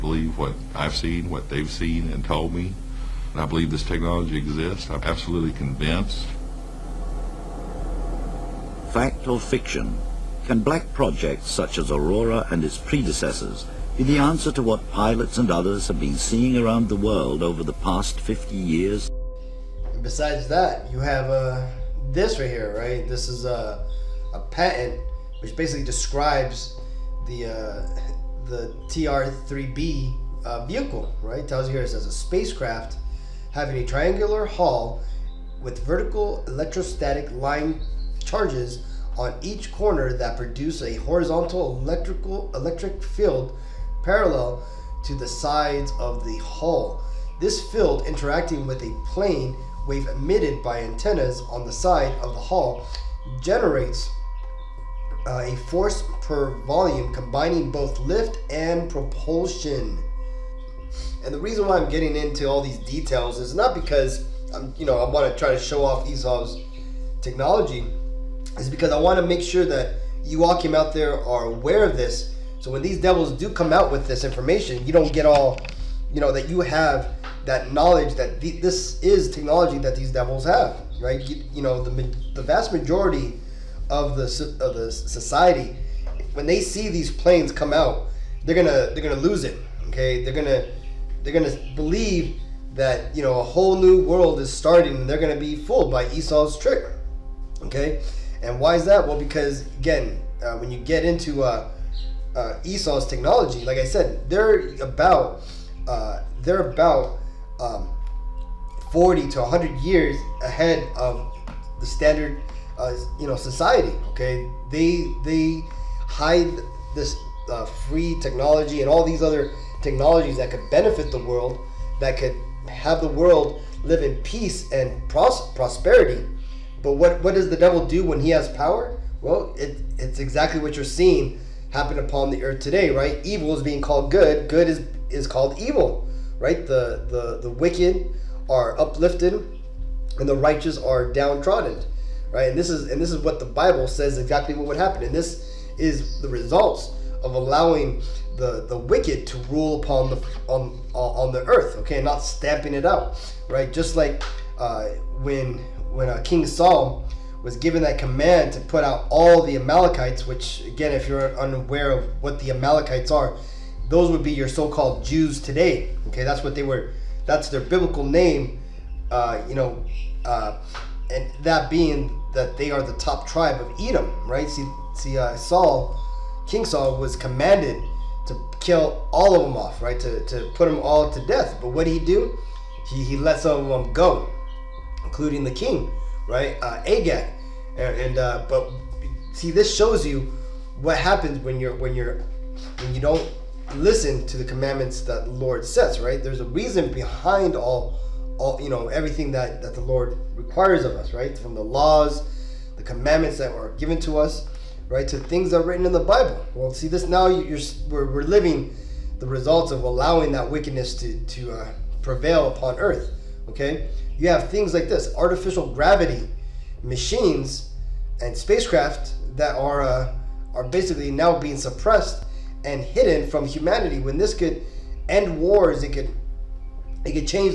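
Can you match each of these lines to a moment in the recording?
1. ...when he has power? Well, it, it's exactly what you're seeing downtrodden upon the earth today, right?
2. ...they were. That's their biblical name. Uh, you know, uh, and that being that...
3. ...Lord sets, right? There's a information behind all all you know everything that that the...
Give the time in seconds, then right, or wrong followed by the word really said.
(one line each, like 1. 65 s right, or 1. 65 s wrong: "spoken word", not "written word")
1. 128 s wrong: "happen", not "downtrodden"
2. 166 s right
3. 195 s wrong: "reason", not "information".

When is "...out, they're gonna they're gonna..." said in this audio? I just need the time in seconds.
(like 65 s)
87 s.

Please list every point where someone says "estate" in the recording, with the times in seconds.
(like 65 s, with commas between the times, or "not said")
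not said.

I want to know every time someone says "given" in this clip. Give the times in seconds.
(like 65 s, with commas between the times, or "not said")
157 s, 203 s.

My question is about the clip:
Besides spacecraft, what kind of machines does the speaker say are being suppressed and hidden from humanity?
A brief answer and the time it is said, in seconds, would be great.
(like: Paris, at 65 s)
Artificial gravity machines, at 215 s.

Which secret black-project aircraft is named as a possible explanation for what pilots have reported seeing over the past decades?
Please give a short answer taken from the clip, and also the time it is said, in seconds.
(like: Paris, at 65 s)
Aurora, at 11 s.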